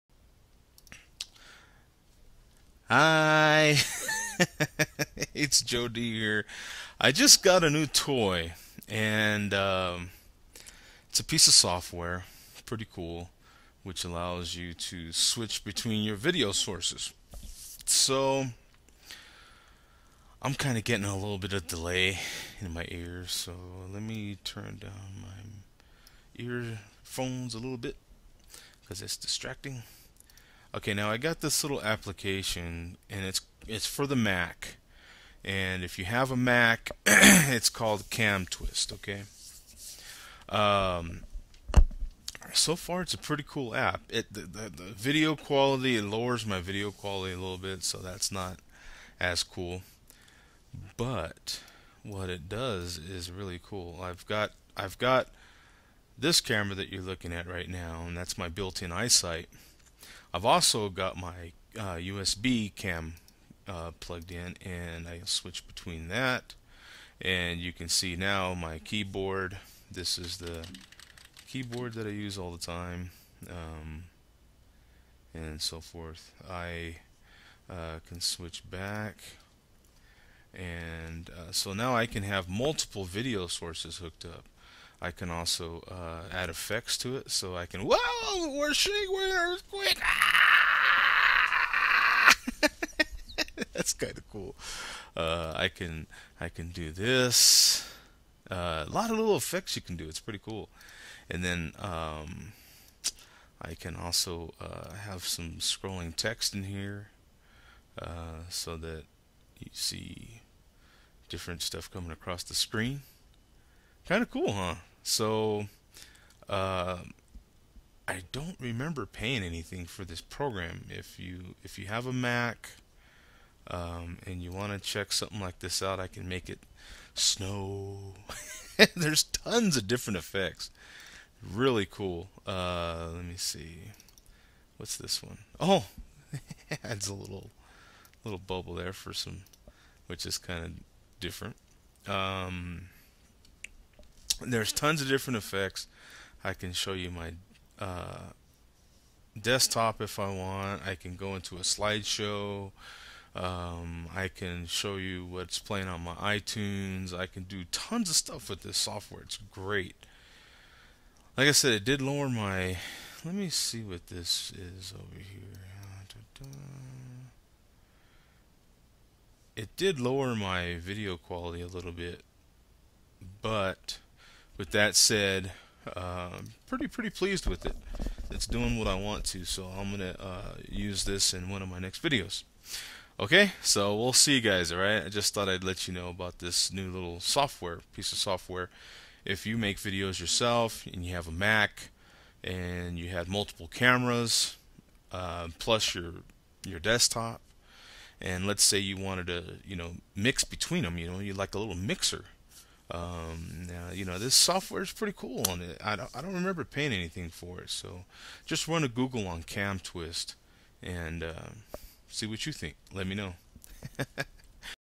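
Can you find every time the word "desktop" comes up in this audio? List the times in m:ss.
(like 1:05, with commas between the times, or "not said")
2:29, 3:16.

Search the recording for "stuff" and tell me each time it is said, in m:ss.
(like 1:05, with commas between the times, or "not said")
1:51, 2:38.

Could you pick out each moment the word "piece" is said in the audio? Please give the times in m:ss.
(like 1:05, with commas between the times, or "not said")
0:11, 3:07.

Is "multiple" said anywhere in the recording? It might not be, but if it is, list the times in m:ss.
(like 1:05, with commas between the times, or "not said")
1:22, 3:13.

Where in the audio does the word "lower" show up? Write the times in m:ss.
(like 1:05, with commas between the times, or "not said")
0:46, 2:42, 2:49.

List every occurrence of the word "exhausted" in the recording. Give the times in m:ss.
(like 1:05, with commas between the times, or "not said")
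not said.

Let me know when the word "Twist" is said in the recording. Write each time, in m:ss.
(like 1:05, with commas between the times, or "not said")
0:38, 3:29.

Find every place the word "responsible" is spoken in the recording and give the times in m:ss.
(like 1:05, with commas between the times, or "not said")
not said.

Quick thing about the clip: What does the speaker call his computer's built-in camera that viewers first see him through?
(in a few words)
eyesight.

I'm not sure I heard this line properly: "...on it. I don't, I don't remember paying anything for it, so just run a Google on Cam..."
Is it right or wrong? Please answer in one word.
right.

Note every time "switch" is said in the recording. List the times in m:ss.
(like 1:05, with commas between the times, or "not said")
0:15, 1:05, 1:18.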